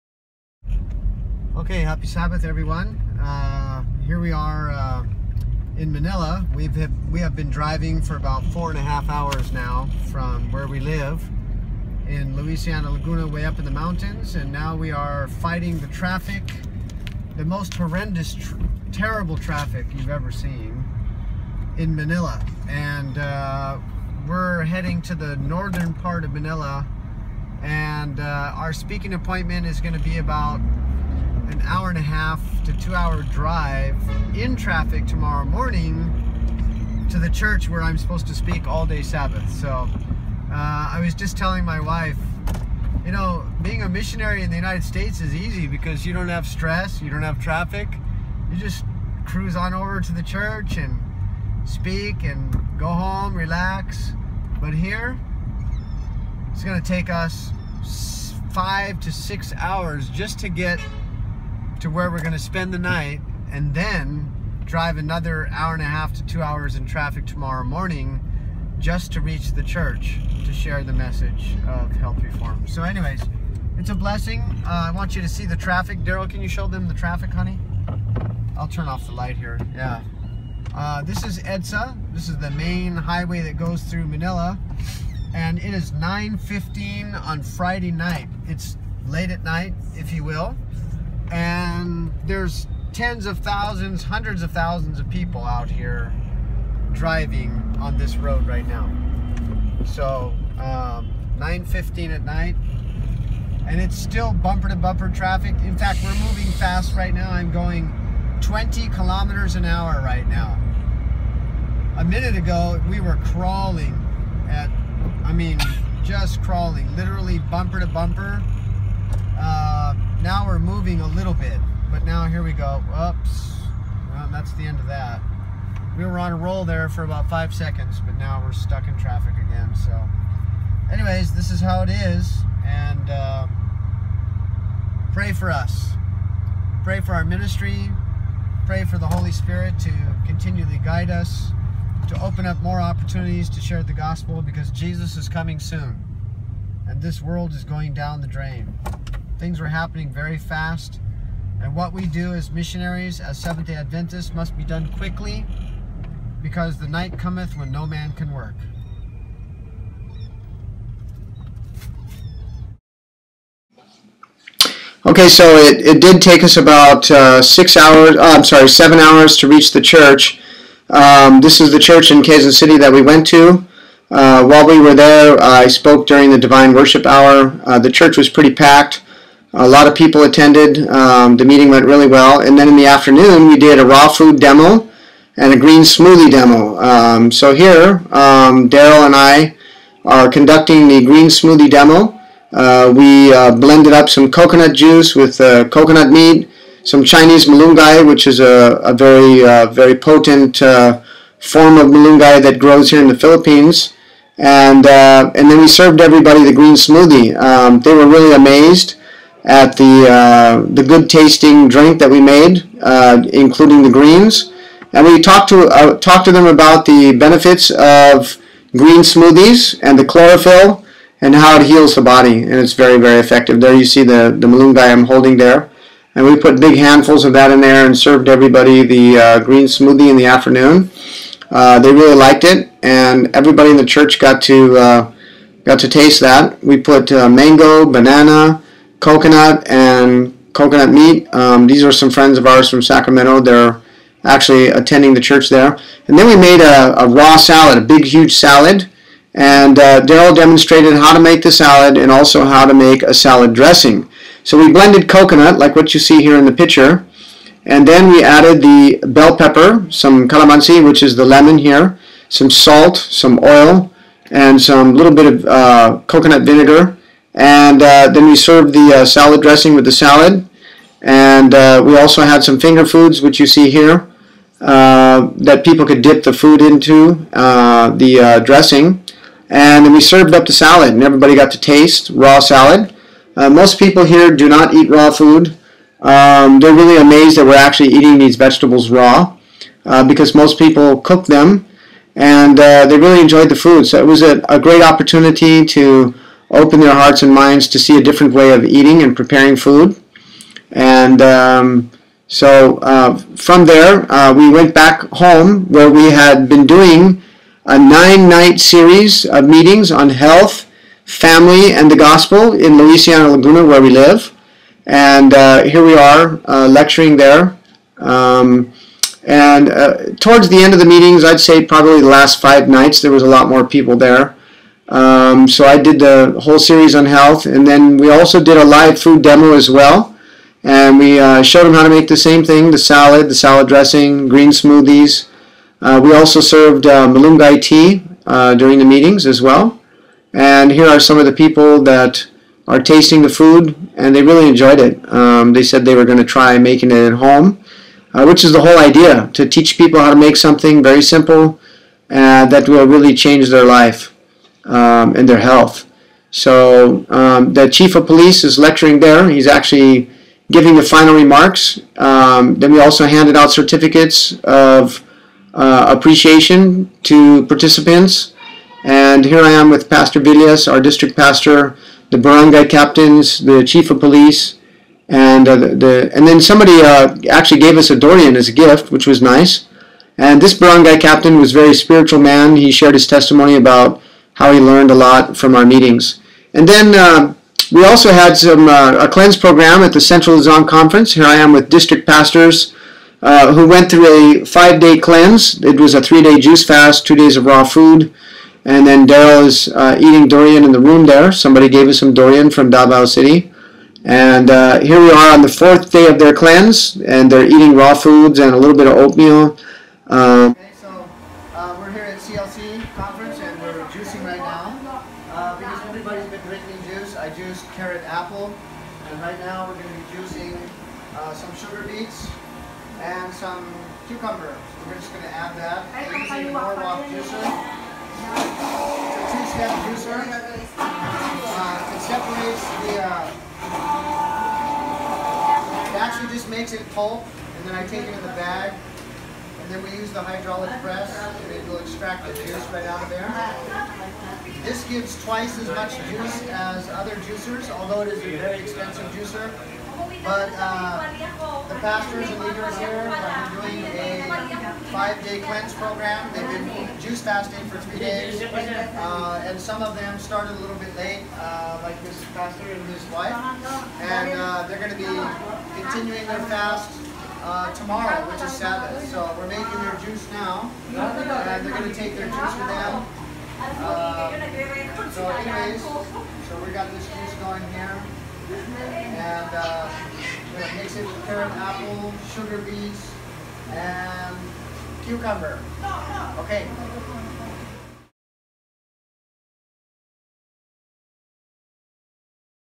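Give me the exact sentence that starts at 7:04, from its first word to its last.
So we're just going to add that.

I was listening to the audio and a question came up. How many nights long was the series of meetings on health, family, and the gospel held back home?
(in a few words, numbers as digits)
9.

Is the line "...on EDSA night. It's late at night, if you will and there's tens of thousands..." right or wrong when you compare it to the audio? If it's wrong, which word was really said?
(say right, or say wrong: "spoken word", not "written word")
wrong: "Friday", not "EDSA".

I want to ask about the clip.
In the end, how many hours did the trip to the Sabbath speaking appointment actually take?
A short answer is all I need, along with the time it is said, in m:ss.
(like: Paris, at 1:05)
7 hours, at 2:48.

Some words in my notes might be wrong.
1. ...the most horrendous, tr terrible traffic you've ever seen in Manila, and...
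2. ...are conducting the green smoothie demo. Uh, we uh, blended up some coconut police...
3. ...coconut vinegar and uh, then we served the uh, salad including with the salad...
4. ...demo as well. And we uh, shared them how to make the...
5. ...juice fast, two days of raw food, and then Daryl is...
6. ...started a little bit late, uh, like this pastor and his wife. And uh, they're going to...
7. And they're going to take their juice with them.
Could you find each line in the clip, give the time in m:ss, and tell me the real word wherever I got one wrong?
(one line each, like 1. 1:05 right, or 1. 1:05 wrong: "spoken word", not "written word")
1. 0:17 right
2. 3:10 wrong: "juice", not "police"
3. 4:26 wrong: "dressing", not "including"
4. 5:29 wrong: "showed", not "shared"
5. 6:36 right
6. 7:40 right
7. 7:50 right.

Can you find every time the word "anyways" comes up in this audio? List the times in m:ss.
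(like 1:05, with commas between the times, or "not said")
1:12, 2:10, 7:55.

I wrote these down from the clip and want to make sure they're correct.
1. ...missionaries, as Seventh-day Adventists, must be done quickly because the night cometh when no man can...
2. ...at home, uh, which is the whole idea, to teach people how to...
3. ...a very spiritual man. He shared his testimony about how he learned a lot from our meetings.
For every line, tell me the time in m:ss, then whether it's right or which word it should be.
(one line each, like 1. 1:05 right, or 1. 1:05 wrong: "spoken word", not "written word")
1. 2:32 right
2. 5:47 right
3. 6:21 right.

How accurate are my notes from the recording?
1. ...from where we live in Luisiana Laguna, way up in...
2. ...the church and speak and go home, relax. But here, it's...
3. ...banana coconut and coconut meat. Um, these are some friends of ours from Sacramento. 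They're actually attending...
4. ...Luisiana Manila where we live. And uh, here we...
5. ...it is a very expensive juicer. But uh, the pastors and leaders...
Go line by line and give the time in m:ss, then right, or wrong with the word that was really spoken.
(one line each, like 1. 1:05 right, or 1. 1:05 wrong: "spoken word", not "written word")
1. 0:10 right
2. 0:50 right
3. 3:57 right
4. 5:12 wrong: "Laguna", not "Manila"
5. 7:28 right.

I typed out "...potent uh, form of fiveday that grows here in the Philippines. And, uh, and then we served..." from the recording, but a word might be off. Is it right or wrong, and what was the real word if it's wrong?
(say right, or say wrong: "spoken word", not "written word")
wrong: "malunggay", not "fiveday".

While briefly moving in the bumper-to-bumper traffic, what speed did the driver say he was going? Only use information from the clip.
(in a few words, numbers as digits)
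20 kilometers an hour.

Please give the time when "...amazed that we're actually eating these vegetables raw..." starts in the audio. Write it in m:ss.
4:46.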